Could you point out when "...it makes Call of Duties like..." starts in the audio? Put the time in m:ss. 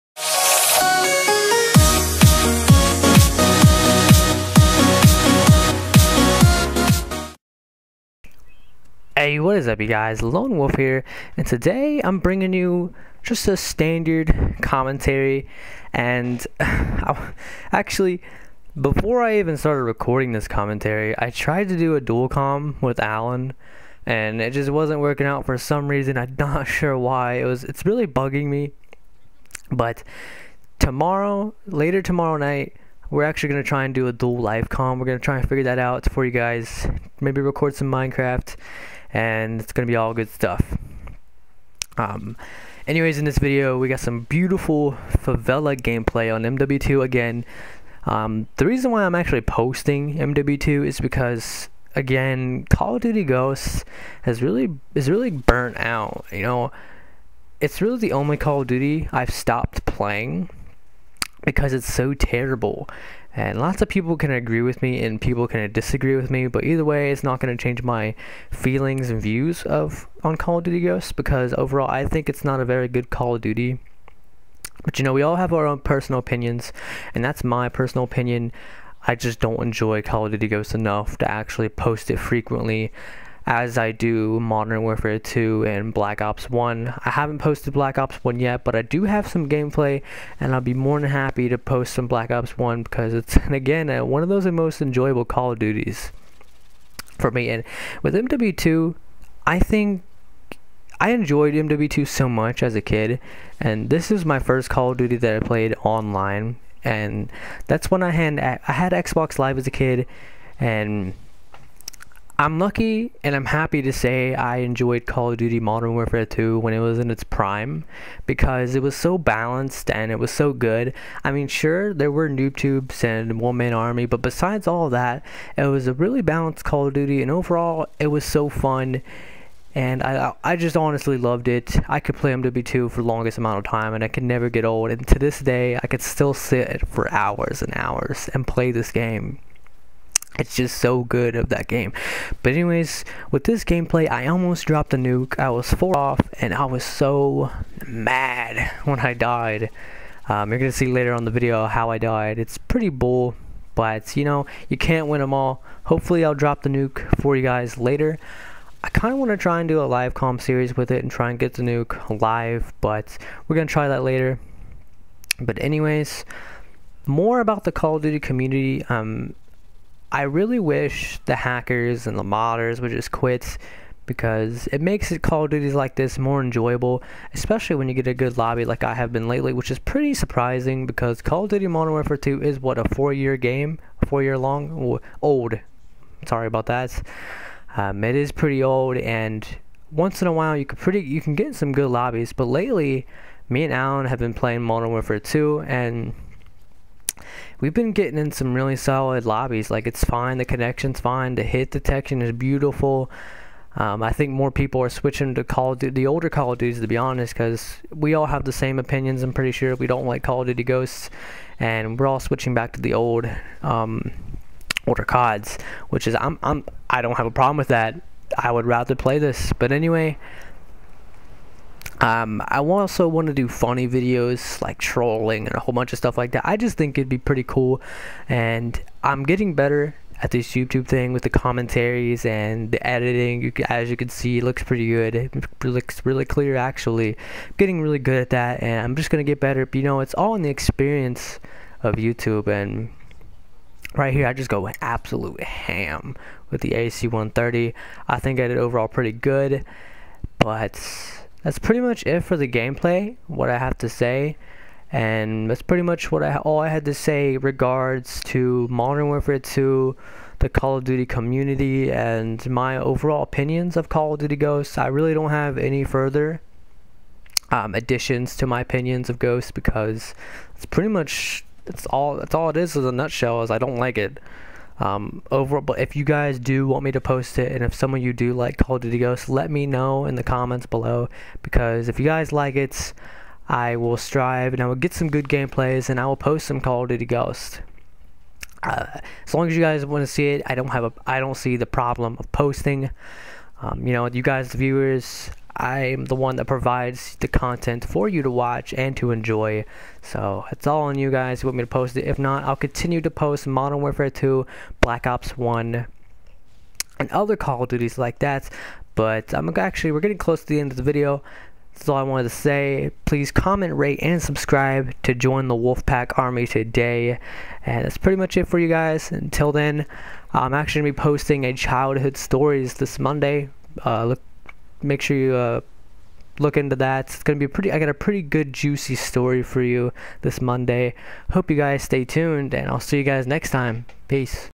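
2:54.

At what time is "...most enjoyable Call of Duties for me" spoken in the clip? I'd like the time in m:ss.
1:34.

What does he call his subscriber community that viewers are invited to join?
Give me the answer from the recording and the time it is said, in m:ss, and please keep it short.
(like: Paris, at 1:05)
Wolfpack Army, at 5:15.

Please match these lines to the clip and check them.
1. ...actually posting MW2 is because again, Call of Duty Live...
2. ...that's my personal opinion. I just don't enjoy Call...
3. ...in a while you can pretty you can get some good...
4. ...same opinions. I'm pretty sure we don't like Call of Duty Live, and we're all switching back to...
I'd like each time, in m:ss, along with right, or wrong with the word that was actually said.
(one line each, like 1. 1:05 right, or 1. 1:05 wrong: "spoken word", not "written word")
1. 0:49 wrong: "Ghosts", not "Live"
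2. 1:17 right
3. 3:10 right
4. 3:28 wrong: "Ghosts", not "Live".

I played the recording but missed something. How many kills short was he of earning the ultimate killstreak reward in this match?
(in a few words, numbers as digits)
4.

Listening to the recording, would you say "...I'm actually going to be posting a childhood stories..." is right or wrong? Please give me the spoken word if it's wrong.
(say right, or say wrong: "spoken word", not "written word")
right.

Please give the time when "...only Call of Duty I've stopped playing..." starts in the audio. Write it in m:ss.
0:58.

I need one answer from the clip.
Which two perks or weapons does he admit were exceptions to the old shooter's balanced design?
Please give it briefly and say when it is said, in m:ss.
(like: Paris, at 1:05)
noob tubes and one man army, at 2:02.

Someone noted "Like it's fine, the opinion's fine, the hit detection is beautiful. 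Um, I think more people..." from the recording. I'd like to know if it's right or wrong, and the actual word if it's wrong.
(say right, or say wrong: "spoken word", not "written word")
wrong: "connection", not "opinion".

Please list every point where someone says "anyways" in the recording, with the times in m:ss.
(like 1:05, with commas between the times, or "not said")
0:42, 2:22, 2:45, 3:39.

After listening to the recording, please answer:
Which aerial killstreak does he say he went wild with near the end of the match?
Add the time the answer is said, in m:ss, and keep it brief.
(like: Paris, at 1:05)
AC-130, at 4:06.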